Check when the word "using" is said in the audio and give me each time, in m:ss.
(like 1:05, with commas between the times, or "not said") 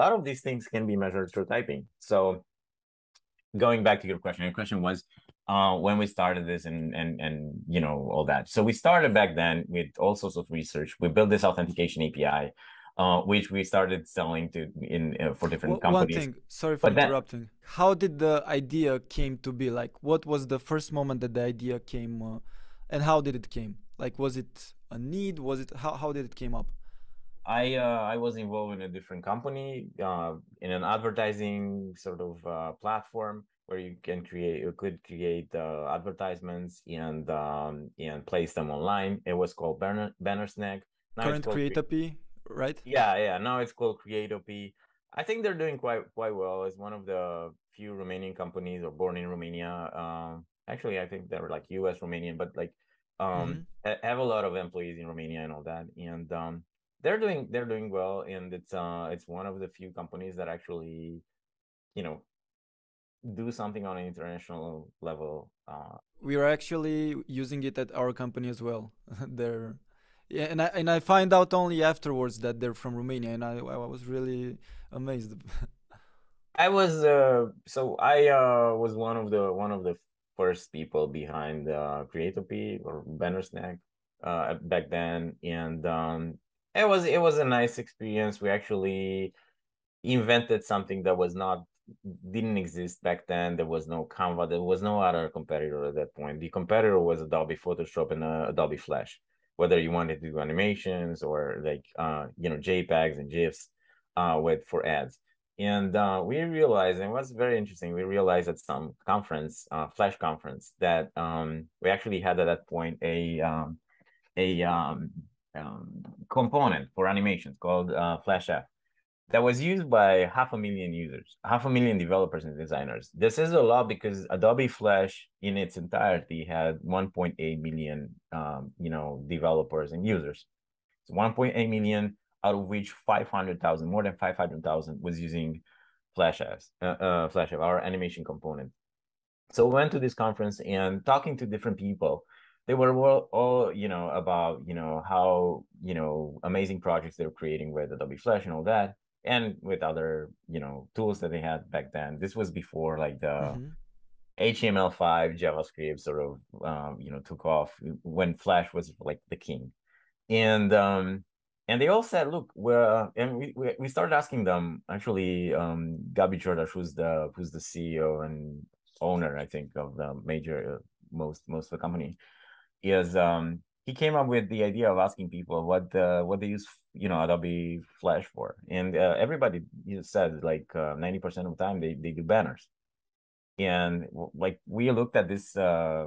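1:07, 2:15.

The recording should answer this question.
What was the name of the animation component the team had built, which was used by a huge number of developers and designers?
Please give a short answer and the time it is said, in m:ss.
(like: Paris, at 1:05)
FlashEff, at 1:58.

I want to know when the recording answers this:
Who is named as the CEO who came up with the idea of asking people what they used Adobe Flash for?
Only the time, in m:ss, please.
2:46.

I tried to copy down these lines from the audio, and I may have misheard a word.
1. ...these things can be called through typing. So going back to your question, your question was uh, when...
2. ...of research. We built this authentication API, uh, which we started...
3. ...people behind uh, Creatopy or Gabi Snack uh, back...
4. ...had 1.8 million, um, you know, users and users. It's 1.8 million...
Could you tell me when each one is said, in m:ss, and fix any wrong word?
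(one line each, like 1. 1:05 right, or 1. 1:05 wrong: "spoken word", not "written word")
1. 0:00 wrong: "measured", not "called"
2. 0:10 right
3. 1:20 wrong: "Banner", not "Gabi"
4. 2:06 wrong: "developers", not "users".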